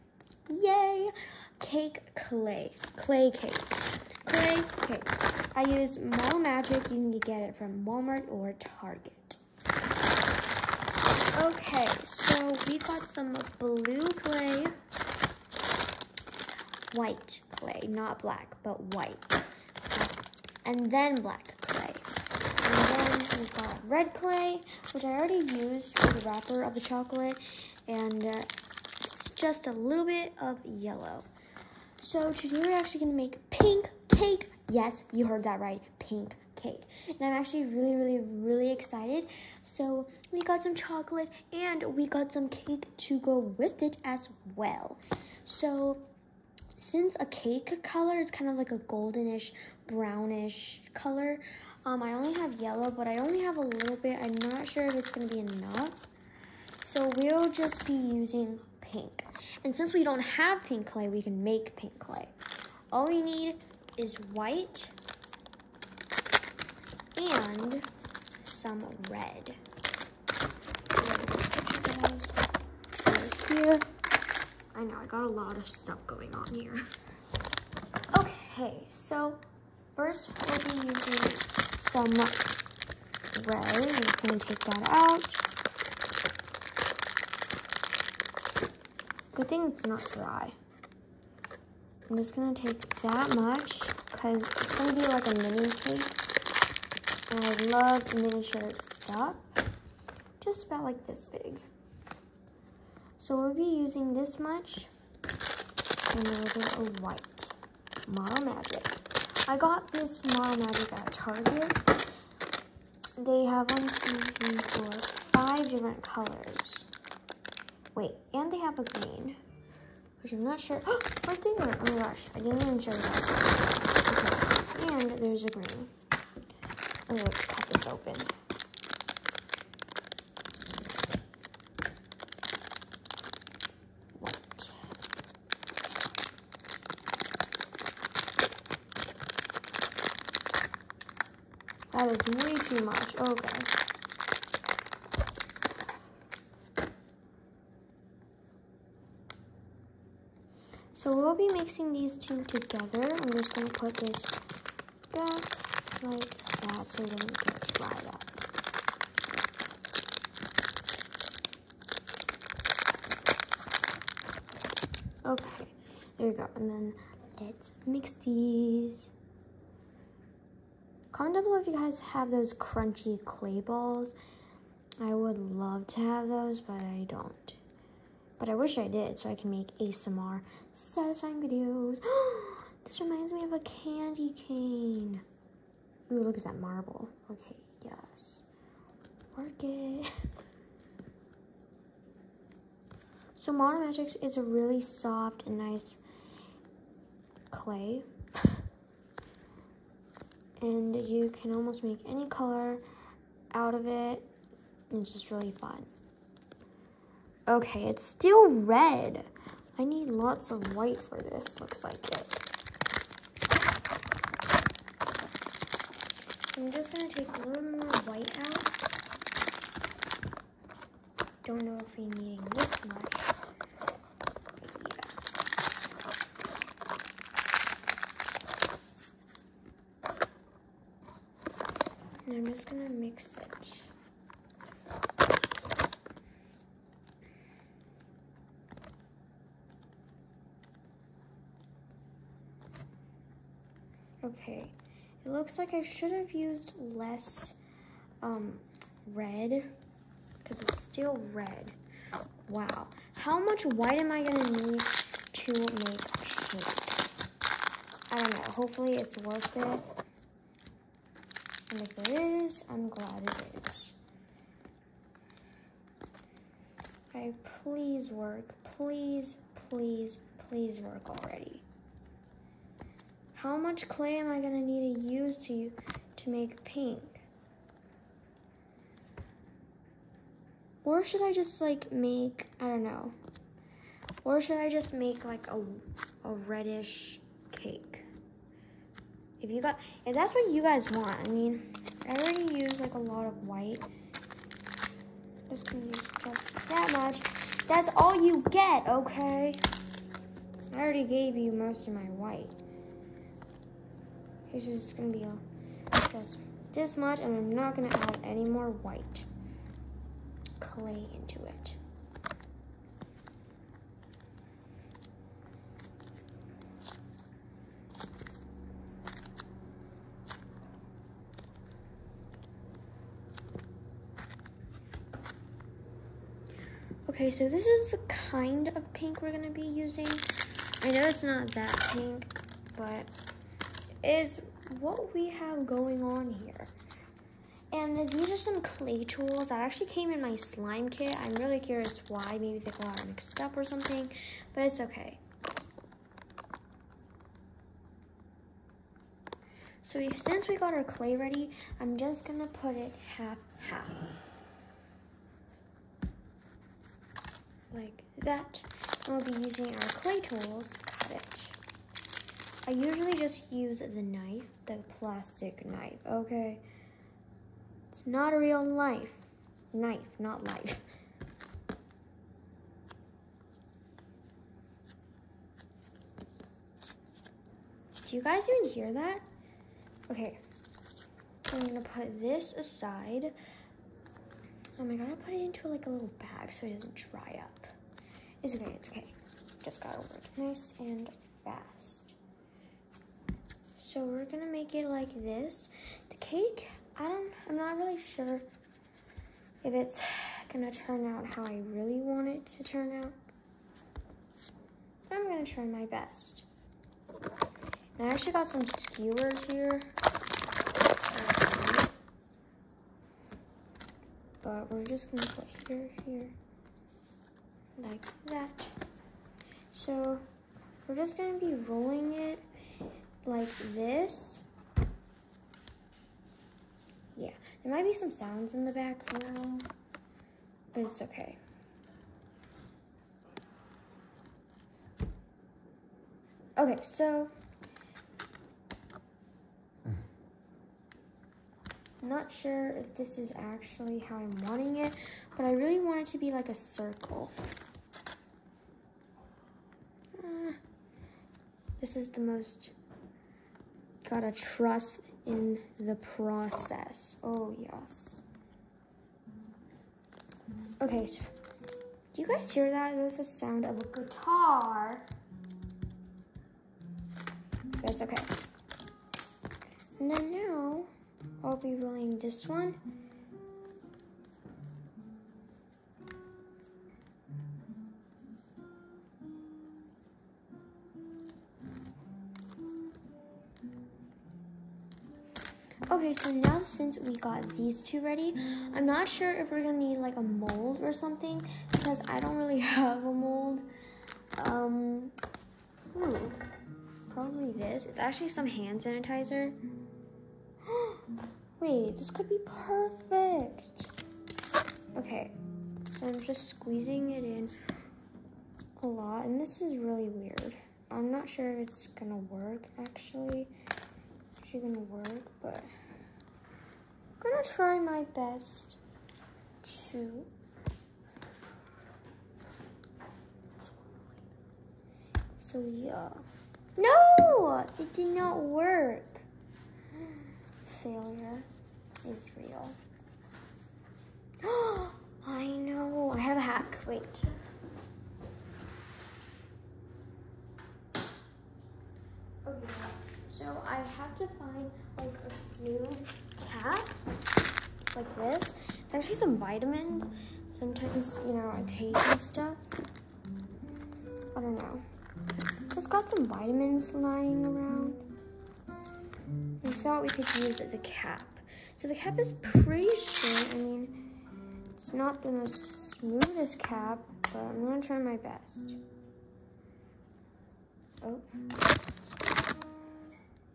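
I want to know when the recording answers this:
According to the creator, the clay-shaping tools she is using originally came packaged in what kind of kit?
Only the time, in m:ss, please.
5:40.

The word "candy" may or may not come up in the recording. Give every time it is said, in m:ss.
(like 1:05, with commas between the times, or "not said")
3:03.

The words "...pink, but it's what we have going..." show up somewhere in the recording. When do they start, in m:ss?
5:31.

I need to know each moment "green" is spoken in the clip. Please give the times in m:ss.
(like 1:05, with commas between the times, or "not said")
1:58, 2:05.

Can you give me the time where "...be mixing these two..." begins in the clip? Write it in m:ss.
2:31.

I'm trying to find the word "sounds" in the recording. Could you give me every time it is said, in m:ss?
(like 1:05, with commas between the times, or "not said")
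7:08, 7:43.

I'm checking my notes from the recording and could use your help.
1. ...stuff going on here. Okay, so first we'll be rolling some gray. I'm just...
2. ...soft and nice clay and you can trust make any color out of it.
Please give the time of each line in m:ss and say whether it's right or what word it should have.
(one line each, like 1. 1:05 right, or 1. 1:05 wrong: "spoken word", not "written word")
1. 1:15 wrong: "using", not "rolling"
2. 3:14 wrong: "almost", not "trust".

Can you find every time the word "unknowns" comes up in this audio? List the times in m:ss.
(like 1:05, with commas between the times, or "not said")
not said.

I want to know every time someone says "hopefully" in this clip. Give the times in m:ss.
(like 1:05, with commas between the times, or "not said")
4:18.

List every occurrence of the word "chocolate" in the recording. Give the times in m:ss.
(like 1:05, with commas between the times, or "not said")
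0:26, 0:40.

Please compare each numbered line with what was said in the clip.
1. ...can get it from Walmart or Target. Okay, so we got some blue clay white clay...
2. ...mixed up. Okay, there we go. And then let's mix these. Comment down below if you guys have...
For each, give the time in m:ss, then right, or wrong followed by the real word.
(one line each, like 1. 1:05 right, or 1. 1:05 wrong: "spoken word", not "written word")
1. 0:06 right
2. 2:37 wrong: "dried", not "mixed".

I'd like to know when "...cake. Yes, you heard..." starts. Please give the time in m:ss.
0:34.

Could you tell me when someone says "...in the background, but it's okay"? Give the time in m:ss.
7:08.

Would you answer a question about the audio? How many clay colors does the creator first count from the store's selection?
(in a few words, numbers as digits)
5.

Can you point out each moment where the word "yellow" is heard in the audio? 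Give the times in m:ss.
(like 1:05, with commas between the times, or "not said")
0:30, 0:52.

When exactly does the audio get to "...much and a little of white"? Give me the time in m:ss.
1:44.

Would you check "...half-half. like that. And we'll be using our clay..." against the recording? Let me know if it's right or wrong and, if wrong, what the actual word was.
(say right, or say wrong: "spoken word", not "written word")
right.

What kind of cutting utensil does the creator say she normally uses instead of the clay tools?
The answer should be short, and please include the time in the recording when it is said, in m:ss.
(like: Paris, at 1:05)
Plastic knife, at 6:04.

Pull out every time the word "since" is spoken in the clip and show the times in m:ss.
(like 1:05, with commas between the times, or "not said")
0:46, 0:59, 5:50, 8:06.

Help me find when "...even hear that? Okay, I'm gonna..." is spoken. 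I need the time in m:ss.
6:18.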